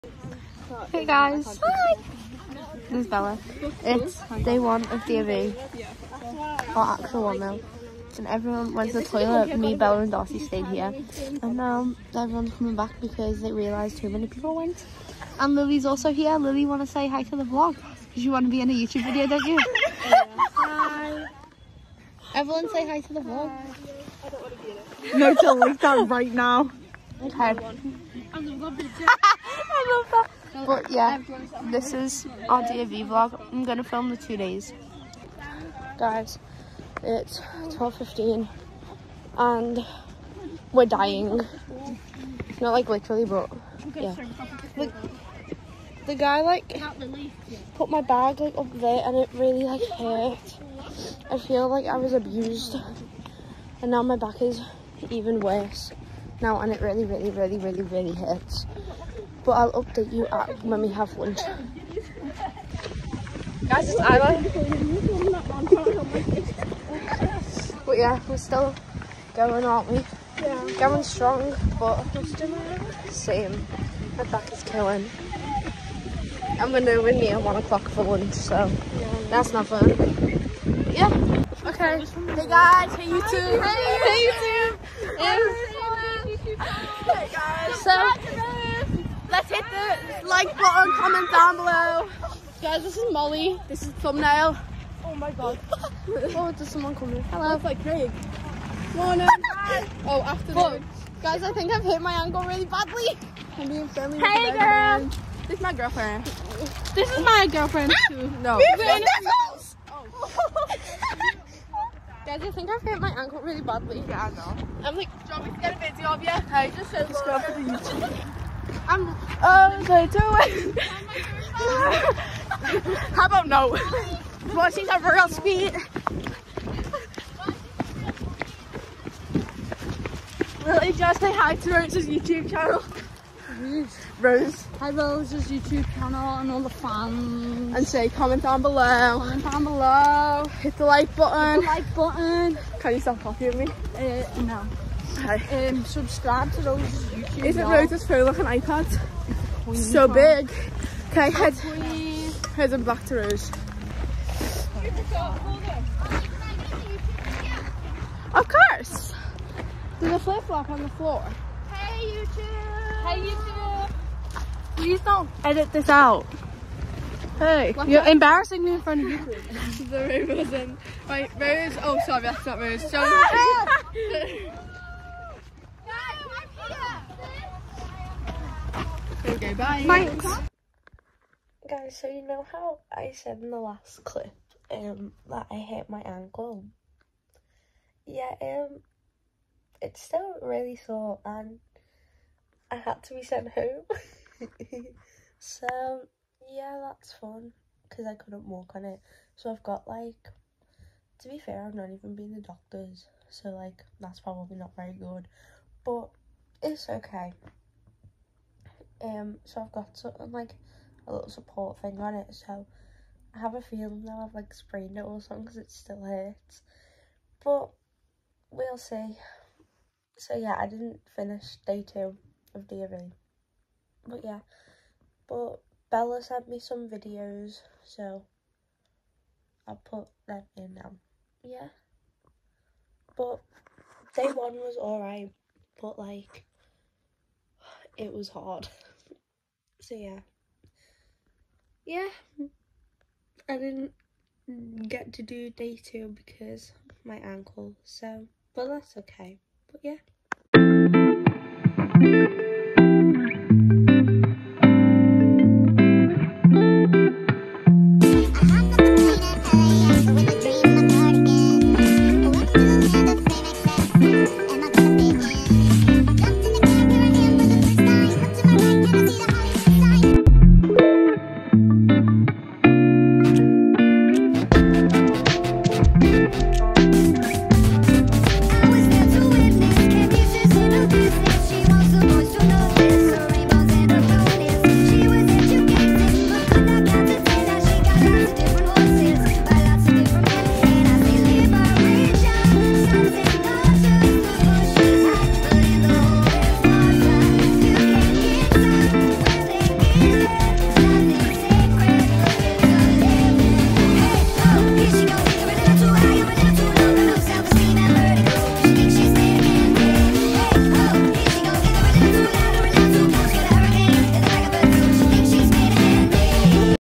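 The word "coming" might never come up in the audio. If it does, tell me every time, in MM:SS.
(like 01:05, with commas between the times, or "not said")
00:12, 01:36.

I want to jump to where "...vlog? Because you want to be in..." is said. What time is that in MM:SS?
00:17.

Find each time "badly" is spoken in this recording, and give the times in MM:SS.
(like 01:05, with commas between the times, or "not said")
01:42, 01:53.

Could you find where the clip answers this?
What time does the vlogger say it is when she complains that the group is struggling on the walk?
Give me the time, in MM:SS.
00:37.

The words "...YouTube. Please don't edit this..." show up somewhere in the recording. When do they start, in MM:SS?
02:43.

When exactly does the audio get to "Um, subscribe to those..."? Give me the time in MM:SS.
02:25.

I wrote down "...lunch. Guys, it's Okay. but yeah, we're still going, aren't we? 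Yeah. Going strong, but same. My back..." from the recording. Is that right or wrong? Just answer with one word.
wrong.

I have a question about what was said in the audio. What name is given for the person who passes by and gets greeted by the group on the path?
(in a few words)
Craig.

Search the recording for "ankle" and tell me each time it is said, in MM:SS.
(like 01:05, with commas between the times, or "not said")
01:42, 01:53, 03:06, 04:07.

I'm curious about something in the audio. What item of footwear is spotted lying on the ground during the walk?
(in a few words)
Flip-flop.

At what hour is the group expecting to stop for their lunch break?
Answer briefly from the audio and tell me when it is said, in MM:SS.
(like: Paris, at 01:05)
1 o'clock, at 01:17.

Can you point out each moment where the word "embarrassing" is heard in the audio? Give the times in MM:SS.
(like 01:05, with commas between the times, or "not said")
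02:48.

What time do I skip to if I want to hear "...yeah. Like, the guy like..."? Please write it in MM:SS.
00:43.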